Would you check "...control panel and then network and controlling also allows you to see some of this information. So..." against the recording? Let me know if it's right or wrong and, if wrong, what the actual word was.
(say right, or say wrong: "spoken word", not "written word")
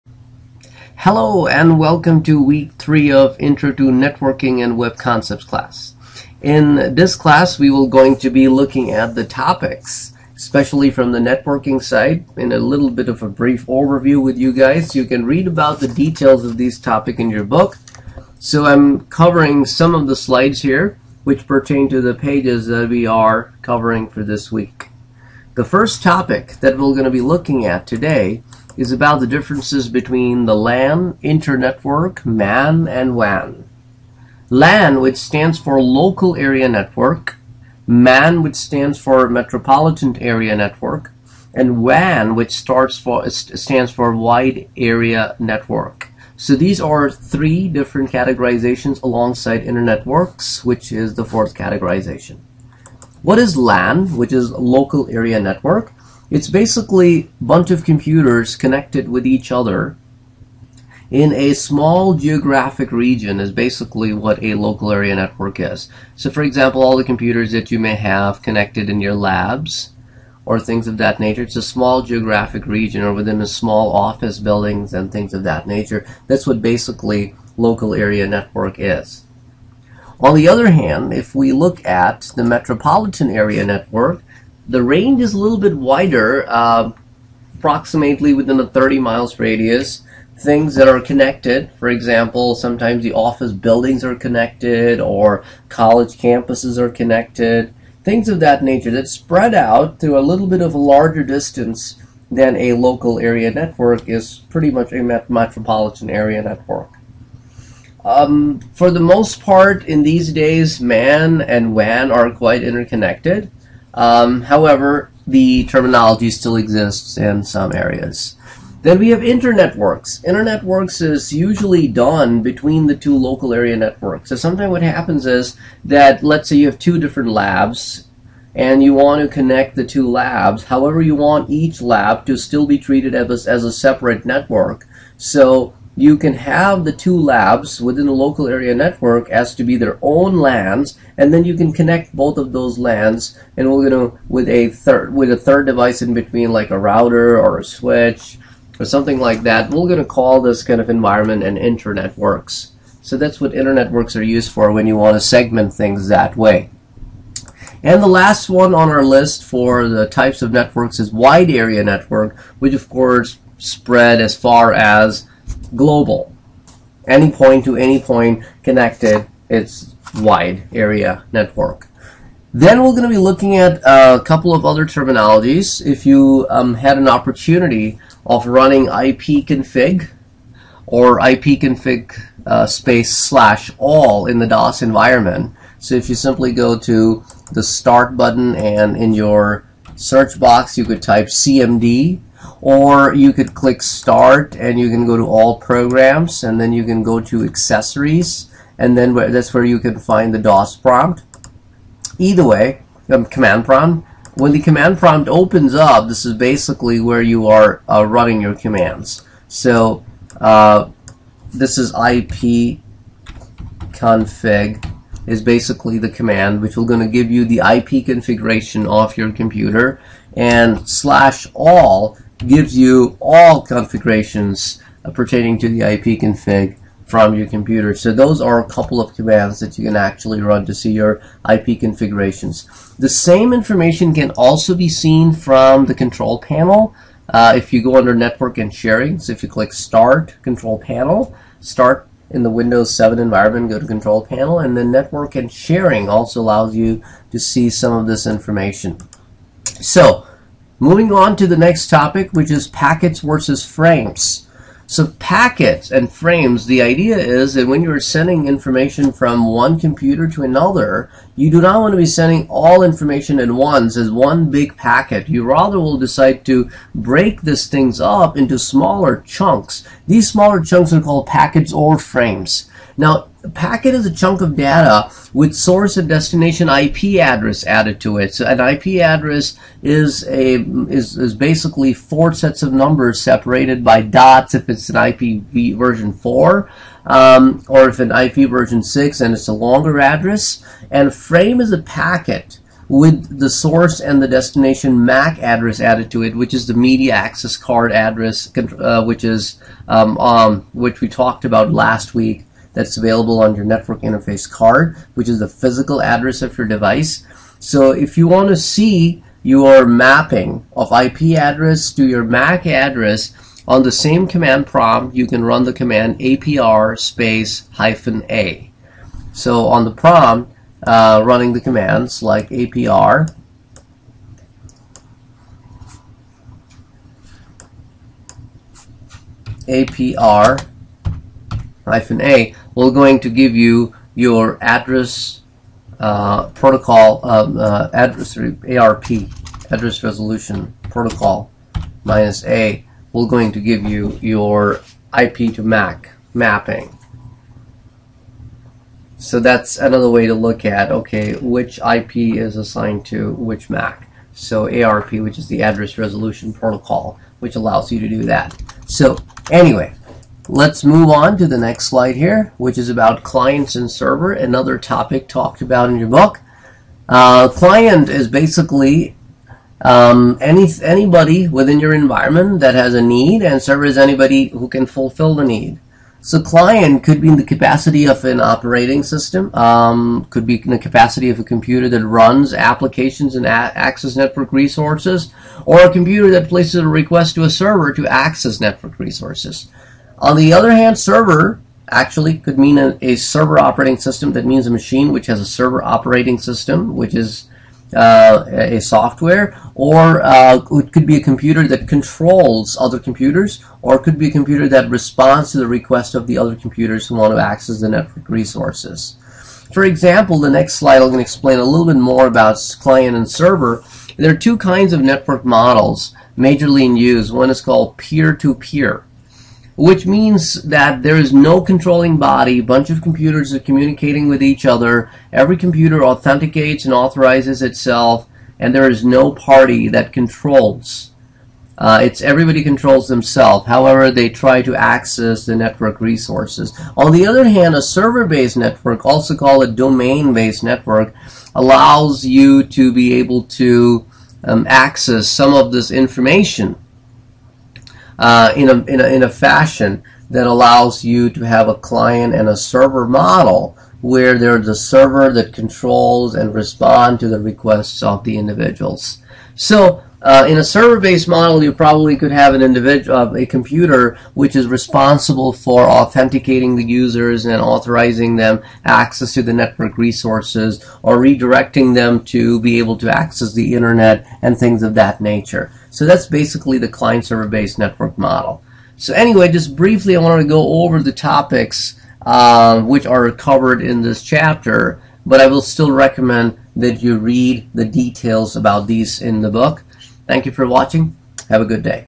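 wrong: "sharing", not "controlling".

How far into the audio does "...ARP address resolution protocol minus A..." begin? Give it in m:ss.
5:38.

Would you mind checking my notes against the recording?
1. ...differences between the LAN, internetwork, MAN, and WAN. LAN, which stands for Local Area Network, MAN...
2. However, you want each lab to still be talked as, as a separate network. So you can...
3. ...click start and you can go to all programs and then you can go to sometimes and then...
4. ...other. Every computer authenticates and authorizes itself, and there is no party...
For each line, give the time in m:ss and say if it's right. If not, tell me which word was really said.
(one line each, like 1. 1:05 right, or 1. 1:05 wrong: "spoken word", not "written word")
1. 0:29 right
2. 2:10 wrong: "treated", not "talked"
3. 3:13 wrong: "accessories", not "sometimes"
4. 7:04 right.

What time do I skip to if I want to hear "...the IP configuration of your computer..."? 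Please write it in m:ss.
3:37.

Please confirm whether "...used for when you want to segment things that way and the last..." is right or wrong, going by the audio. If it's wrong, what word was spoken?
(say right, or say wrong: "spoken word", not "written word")
right.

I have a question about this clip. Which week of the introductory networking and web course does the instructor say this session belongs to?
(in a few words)
3.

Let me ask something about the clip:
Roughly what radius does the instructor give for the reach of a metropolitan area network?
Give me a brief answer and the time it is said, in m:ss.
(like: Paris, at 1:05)
30 miles, at 1:28.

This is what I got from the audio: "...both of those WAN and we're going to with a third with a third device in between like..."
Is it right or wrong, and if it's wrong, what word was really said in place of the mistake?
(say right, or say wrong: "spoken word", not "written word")
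wrong: "LANs", not "WAN".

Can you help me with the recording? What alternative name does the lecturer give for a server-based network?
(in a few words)
domain-based network.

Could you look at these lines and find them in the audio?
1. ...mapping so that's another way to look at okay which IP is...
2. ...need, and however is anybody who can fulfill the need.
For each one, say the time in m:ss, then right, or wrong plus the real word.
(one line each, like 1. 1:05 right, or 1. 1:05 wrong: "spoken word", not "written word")
1. 5:46 right
2. 6:13 wrong: "server", not "however".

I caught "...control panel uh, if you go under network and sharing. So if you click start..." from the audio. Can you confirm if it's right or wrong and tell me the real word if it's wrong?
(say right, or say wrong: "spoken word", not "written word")
right.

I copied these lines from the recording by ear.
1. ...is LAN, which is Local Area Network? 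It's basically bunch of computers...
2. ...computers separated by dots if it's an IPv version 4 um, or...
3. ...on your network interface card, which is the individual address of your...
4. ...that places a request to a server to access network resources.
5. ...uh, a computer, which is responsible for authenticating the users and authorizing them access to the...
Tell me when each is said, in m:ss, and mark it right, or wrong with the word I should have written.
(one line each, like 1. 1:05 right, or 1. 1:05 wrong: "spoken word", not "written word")
1. 0:53 right
2. 4:42 wrong: "numbers", not "computers"
3. 5:03 wrong: "physical", not "individual"
4. 6:26 right
5. 7:43 right.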